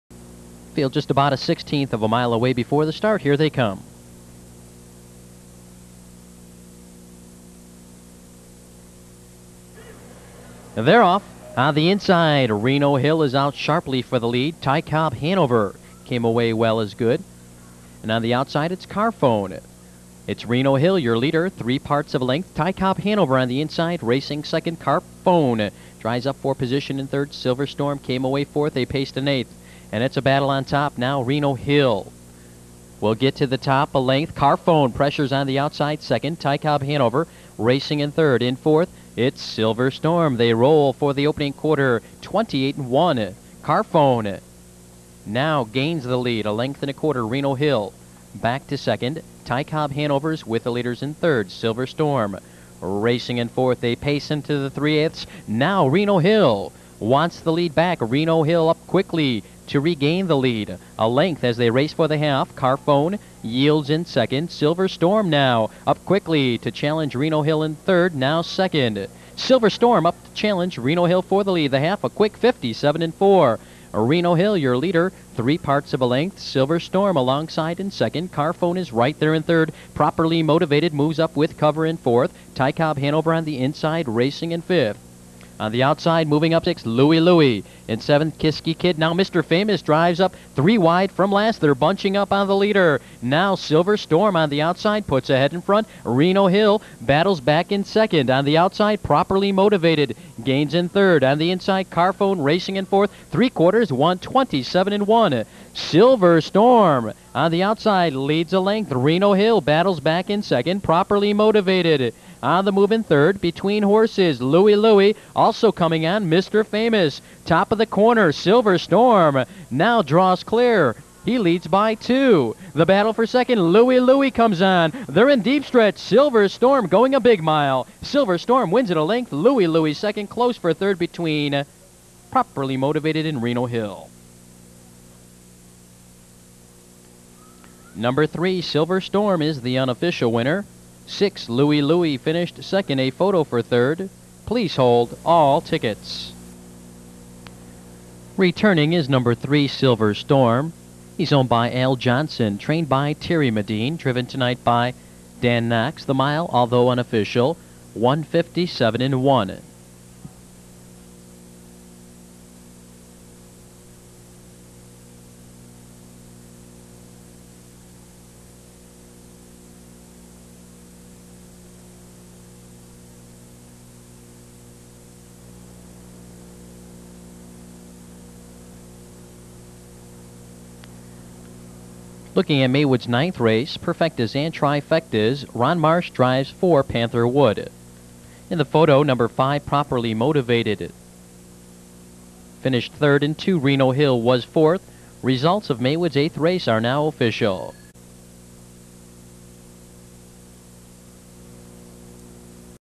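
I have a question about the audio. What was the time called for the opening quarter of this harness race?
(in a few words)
28.1.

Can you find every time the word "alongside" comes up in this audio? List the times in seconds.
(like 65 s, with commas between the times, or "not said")
77 s.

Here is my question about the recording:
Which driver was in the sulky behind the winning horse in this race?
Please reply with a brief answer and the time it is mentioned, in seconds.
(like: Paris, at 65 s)
Dan Knox, at 155 s.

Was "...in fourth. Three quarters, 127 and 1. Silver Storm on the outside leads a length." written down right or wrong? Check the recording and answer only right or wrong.
right.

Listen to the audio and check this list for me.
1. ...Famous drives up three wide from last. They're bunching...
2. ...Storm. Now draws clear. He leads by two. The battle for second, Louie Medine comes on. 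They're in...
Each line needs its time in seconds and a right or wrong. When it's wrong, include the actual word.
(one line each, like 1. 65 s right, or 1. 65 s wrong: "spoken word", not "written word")
1. 89 s right
2. 118 s wrong: "Louie", not "Medine".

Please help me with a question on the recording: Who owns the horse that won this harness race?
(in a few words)
Al Johnson.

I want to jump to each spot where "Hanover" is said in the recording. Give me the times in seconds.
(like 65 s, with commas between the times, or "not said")
15 s, 22 s, 36 s, 49 s, 82 s.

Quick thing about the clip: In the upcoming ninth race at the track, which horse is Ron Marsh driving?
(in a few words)
Panther Wood.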